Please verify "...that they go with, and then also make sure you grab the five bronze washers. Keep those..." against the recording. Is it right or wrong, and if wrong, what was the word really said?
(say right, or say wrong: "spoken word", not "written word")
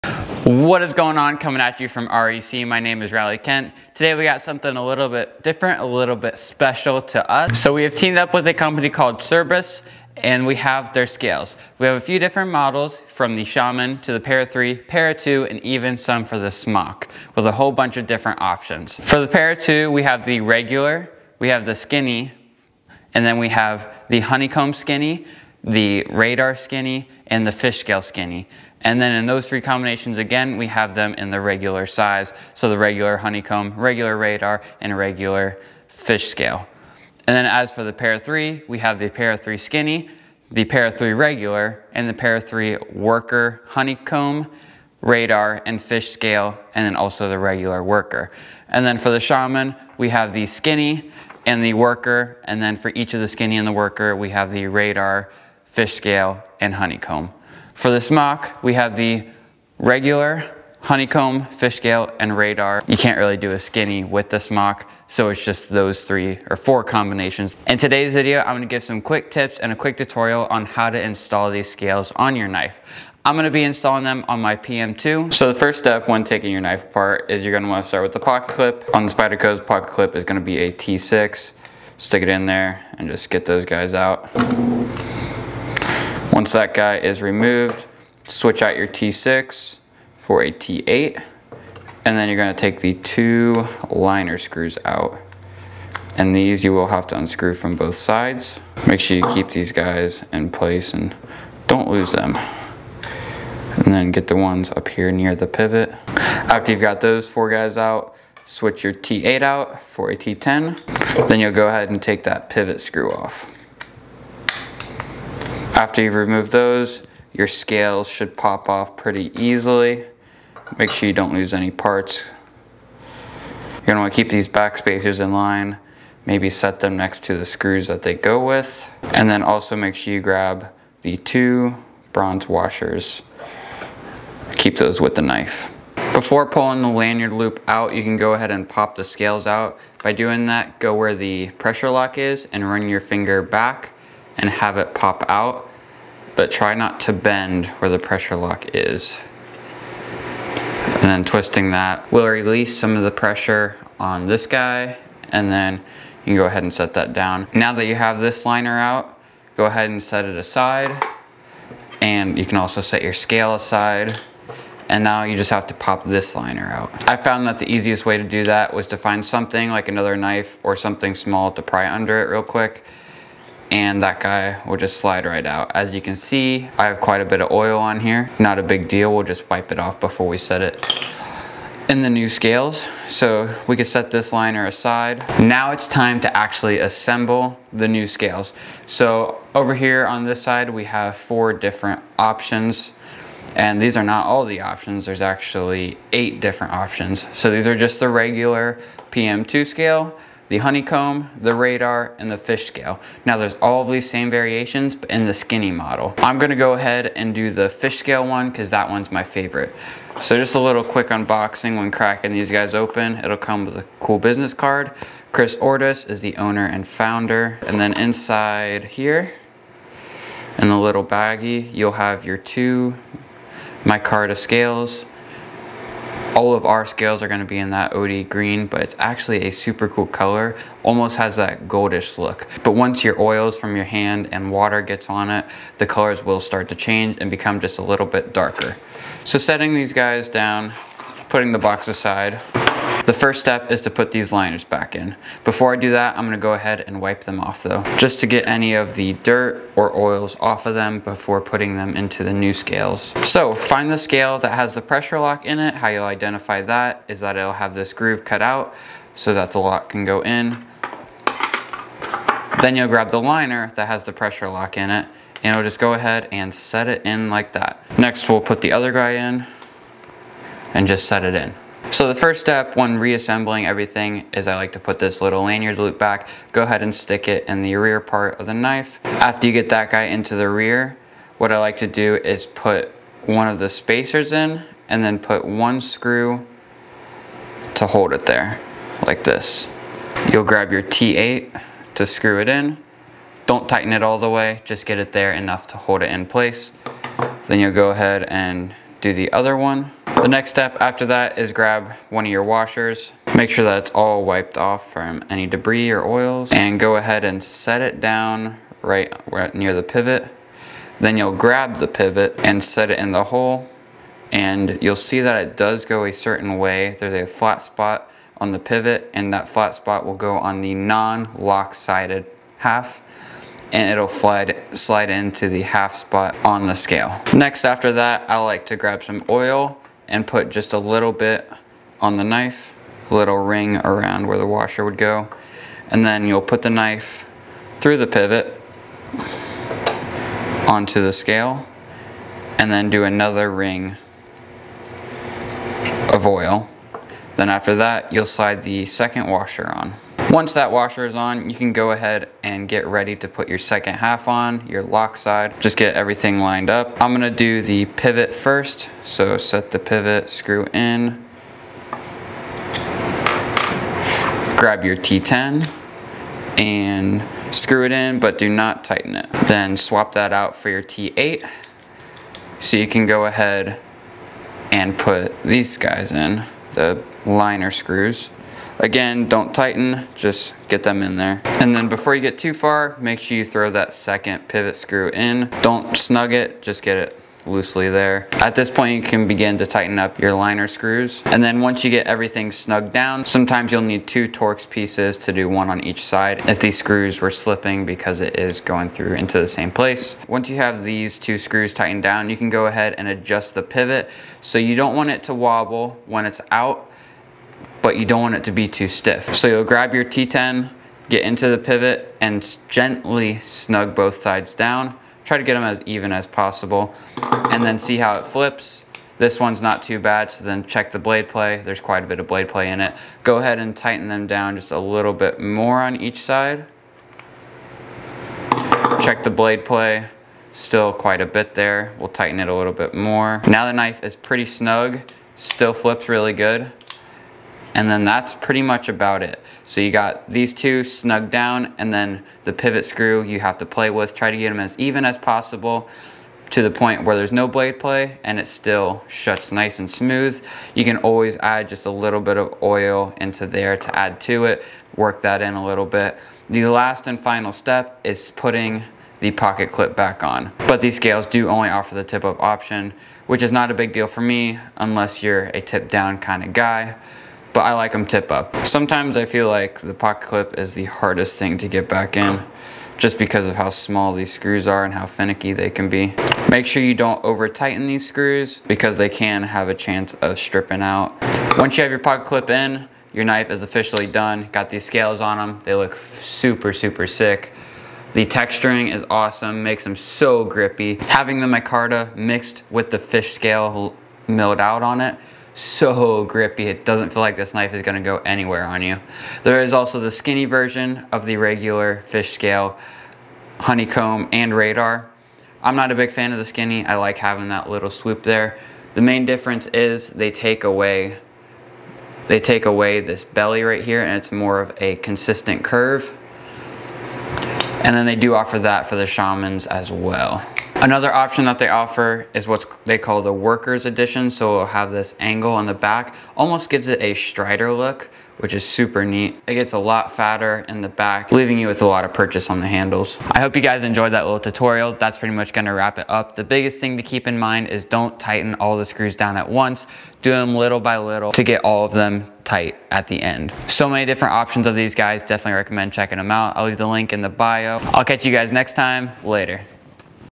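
wrong: "two", not "five".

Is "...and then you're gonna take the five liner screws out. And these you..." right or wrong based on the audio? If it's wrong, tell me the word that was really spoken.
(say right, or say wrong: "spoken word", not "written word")
wrong: "two", not "five".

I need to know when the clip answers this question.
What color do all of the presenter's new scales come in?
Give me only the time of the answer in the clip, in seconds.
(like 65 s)
227 s.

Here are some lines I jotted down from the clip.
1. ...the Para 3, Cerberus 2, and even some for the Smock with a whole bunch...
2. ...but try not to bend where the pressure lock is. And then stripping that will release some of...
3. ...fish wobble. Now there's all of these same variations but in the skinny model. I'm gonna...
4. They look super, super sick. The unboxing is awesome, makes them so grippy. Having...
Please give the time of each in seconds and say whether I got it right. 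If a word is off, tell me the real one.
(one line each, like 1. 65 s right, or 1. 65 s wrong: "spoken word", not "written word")
1. 14 s wrong: "Para", not "Cerberus"
2. 146 s wrong: "twisting", not "stripping"
3. 202 s wrong: "scale", not "wobble"
4. 485 s wrong: "texturing", not "unboxing".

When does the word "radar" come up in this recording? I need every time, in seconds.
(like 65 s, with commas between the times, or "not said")
26 s, 34 s, 45 s, 54 s, 62 s, 201 s, 504 s.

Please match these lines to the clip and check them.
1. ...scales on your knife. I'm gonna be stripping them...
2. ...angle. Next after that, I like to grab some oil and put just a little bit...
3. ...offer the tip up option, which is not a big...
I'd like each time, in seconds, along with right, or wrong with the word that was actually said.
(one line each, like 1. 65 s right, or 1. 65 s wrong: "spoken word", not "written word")
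1. 71 s wrong: "installing", not "stripping"
2. 326 s wrong: "scale", not "angle"
3. 461 s right.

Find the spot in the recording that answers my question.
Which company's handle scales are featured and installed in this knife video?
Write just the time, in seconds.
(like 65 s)
9 s.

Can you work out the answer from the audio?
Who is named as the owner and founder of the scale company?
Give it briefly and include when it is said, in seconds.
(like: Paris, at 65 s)
Chris Ortis, at 215 s.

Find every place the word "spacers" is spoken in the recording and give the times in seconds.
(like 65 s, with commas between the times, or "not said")
124 s, 283 s.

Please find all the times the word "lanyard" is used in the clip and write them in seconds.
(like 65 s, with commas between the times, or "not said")
136 s, 275 s.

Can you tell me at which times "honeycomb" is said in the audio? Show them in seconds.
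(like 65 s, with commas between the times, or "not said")
24 s, 33 s, 43 s, 56 s, 60 s, 200 s, 503 s.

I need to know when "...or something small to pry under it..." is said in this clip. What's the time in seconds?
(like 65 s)
170 s.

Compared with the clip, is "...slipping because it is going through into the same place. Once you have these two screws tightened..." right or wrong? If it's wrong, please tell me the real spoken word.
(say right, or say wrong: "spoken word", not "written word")
right.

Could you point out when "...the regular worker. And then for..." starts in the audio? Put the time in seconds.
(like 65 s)
47 s.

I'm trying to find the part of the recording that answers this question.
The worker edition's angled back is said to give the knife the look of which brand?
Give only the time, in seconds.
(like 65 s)
527 s.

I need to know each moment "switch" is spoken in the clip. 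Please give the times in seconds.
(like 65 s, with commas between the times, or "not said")
88 s, 108 s.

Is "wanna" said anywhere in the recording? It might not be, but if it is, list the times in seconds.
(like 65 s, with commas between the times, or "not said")
77 s, 124 s.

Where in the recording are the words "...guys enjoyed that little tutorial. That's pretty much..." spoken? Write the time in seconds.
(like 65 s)
533 s.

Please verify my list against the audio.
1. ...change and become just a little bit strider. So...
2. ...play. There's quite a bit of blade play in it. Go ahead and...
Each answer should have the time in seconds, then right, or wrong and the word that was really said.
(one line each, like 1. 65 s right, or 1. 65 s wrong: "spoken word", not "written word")
1. 236 s wrong: "darker", not "strider"
2. 421 s right.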